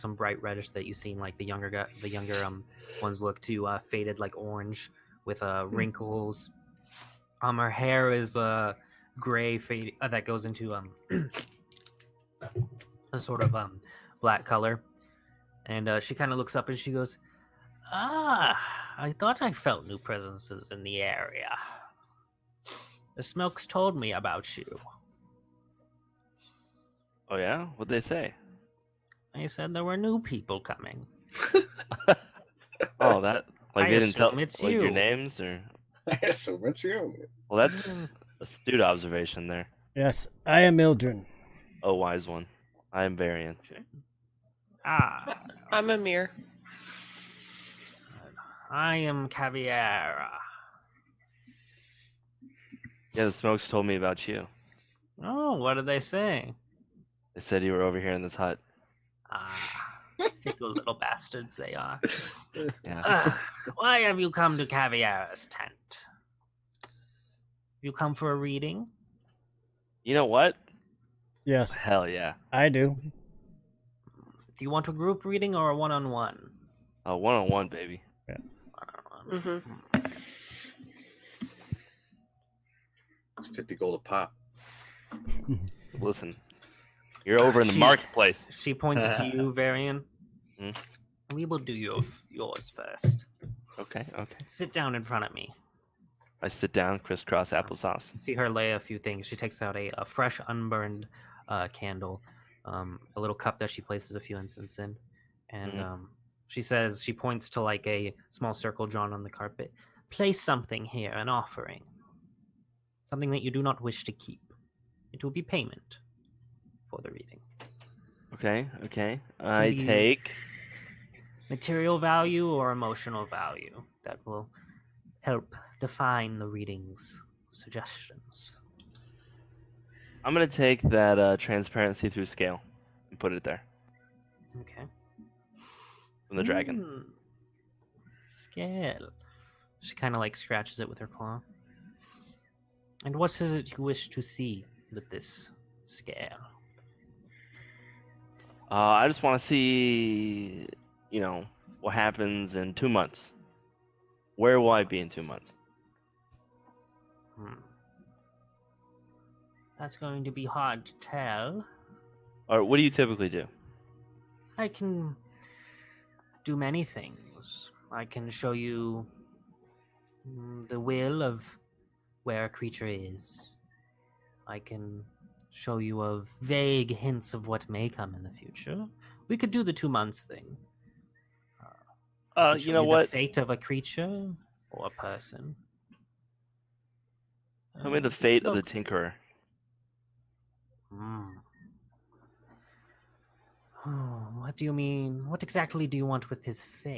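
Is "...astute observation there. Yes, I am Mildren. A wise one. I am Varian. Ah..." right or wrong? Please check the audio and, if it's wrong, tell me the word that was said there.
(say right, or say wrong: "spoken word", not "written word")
right.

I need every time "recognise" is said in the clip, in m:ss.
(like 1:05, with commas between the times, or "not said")
not said.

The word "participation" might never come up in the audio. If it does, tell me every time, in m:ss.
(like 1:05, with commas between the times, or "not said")
not said.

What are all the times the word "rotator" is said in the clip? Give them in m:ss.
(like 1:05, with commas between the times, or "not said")
not said.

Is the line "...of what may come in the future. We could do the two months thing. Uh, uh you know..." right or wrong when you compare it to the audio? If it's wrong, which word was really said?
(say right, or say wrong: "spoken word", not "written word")
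right.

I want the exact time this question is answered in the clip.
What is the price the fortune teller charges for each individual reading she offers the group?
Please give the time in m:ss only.
1:23.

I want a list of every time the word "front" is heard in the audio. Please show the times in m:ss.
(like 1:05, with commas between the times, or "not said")
1:35.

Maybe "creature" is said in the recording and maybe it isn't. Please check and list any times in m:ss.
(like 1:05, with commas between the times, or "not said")
2:52, 3:03.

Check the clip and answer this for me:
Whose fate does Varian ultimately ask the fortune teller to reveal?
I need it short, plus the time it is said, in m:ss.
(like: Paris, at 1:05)
The Tinkerer, at 3:08.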